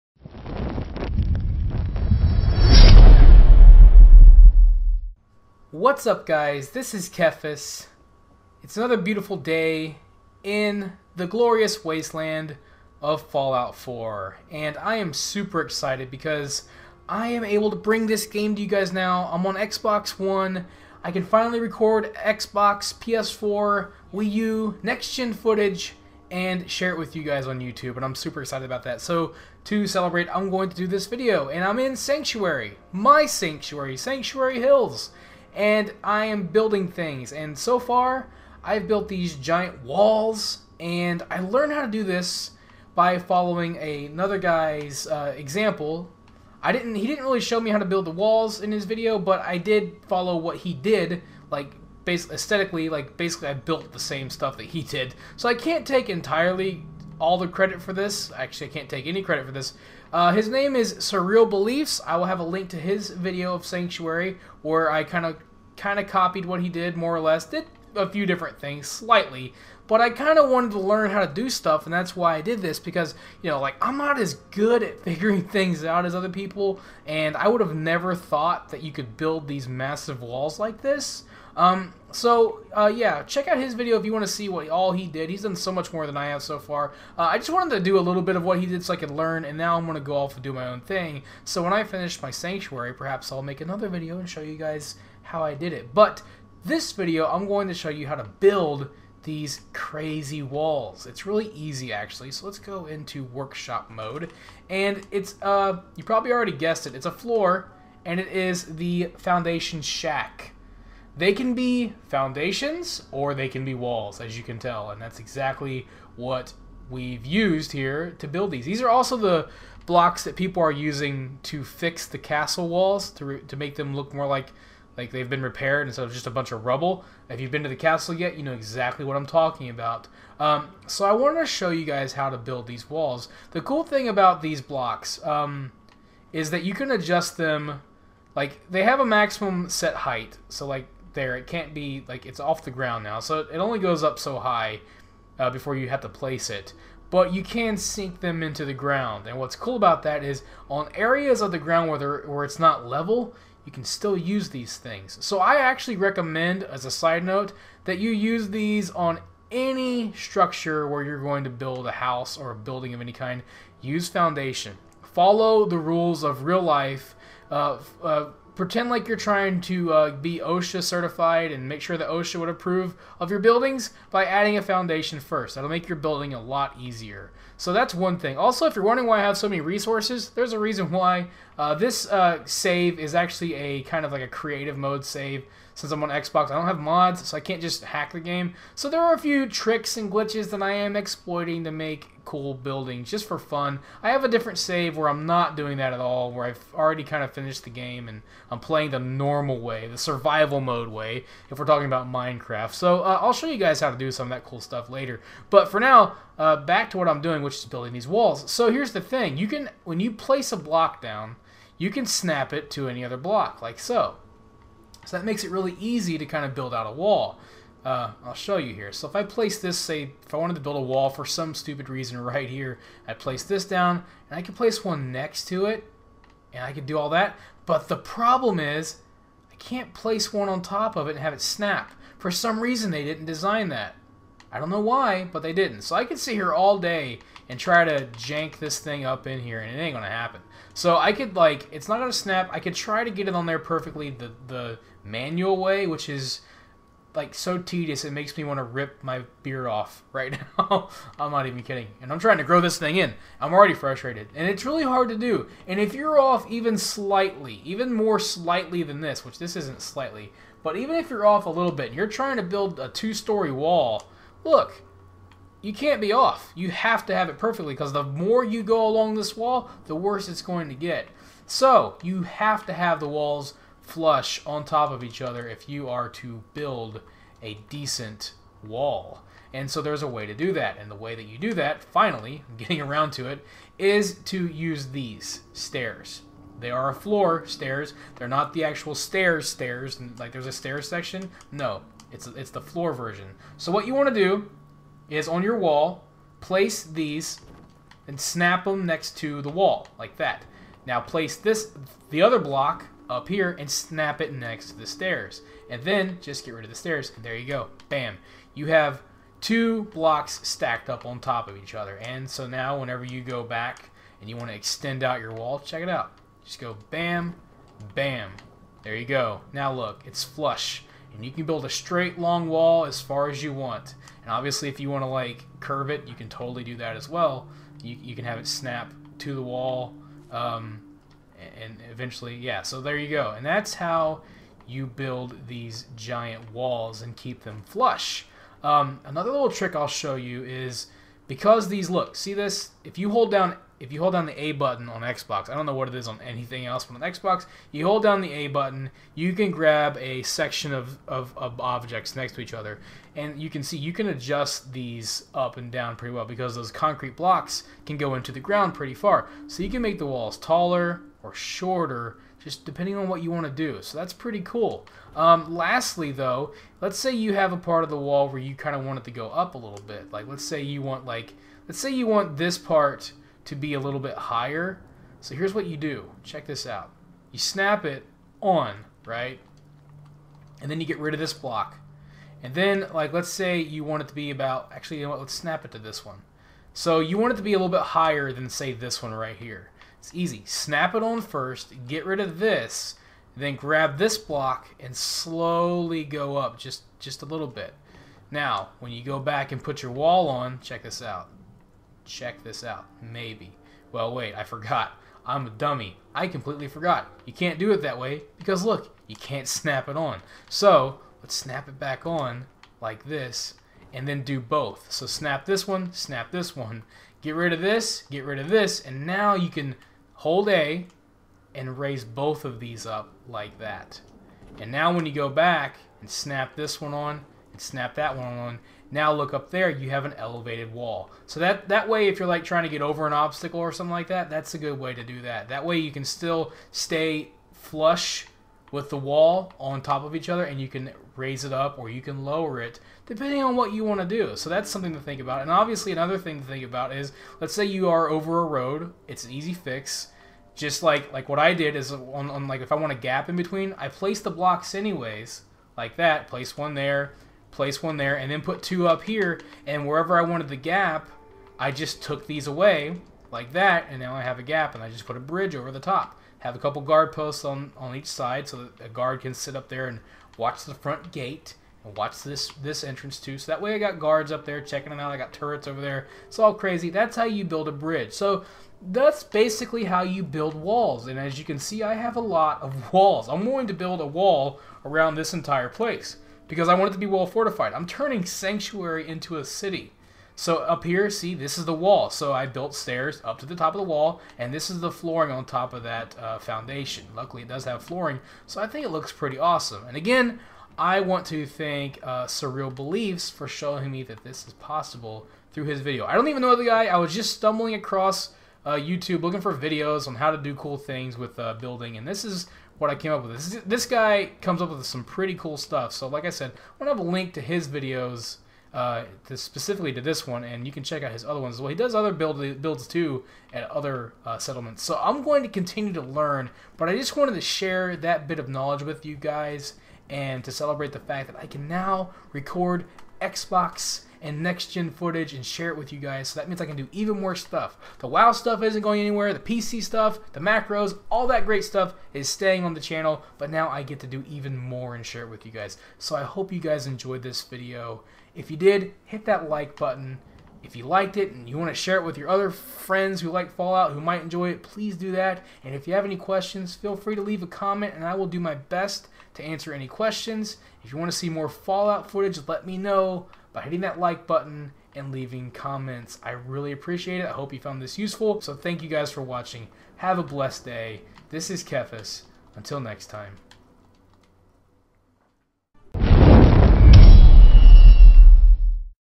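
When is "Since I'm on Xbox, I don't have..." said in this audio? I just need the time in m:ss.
3:05.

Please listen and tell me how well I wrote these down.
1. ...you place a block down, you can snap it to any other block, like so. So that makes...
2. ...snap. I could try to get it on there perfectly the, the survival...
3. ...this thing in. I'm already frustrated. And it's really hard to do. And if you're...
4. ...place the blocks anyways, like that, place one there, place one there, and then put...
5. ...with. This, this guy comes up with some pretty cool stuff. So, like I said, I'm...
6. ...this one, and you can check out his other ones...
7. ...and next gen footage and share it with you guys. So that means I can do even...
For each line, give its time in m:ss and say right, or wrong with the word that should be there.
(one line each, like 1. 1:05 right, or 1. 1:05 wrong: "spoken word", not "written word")
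1. 3:29 right
2. 4:02 wrong: "manual", not "survival"
3. 4:12 right
4. 7:33 right
5. 8:33 right
6. 8:40 right
7. 8:54 right.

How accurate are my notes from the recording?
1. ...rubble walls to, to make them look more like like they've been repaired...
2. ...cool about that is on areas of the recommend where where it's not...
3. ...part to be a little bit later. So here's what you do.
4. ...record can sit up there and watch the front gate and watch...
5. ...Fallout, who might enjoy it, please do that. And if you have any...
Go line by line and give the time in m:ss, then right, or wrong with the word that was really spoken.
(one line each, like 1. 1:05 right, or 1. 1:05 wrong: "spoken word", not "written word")
1. 2:02 wrong: "castle", not "rubble"
2. 2:29 wrong: "ground", not "recommend"
3. 6:12 wrong: "higher", not "later"
4. 7:48 wrong: "guard", not "record"
5. 9:13 right.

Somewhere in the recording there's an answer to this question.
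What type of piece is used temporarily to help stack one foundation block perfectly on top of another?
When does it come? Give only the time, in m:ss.
4:46.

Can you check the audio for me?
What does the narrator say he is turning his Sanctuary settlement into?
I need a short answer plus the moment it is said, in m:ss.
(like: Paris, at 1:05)
a city, at 8:09.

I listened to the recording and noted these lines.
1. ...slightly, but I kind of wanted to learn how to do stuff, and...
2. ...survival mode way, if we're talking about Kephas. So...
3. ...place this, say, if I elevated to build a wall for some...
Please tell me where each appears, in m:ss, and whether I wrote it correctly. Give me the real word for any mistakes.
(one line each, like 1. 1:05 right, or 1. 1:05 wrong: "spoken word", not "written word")
1. 1:08 right
2. 3:19 wrong: "Minecraft", not "Kephas"
3. 3:39 wrong: "wanted", not "elevated".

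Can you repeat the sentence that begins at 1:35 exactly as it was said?
But this video, I'm going to show you how to build these crazy walls.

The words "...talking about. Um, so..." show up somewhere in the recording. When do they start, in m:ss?
2:09.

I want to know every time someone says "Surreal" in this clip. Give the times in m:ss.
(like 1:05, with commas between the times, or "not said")
1:00, 8:22.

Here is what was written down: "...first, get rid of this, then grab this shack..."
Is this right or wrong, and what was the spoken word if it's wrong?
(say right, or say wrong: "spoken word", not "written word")
wrong: "block", not "shack".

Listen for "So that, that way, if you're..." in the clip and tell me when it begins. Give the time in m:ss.
7:11.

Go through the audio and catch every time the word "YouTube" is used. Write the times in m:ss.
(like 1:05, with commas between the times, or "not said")
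0:27, 8:28.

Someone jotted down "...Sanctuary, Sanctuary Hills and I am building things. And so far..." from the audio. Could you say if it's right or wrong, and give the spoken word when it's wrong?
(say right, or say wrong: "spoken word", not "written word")
right.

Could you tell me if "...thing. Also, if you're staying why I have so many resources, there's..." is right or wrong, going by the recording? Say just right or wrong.
wrong.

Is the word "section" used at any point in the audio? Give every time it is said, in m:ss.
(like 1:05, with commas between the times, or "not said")
4:50, 5:50.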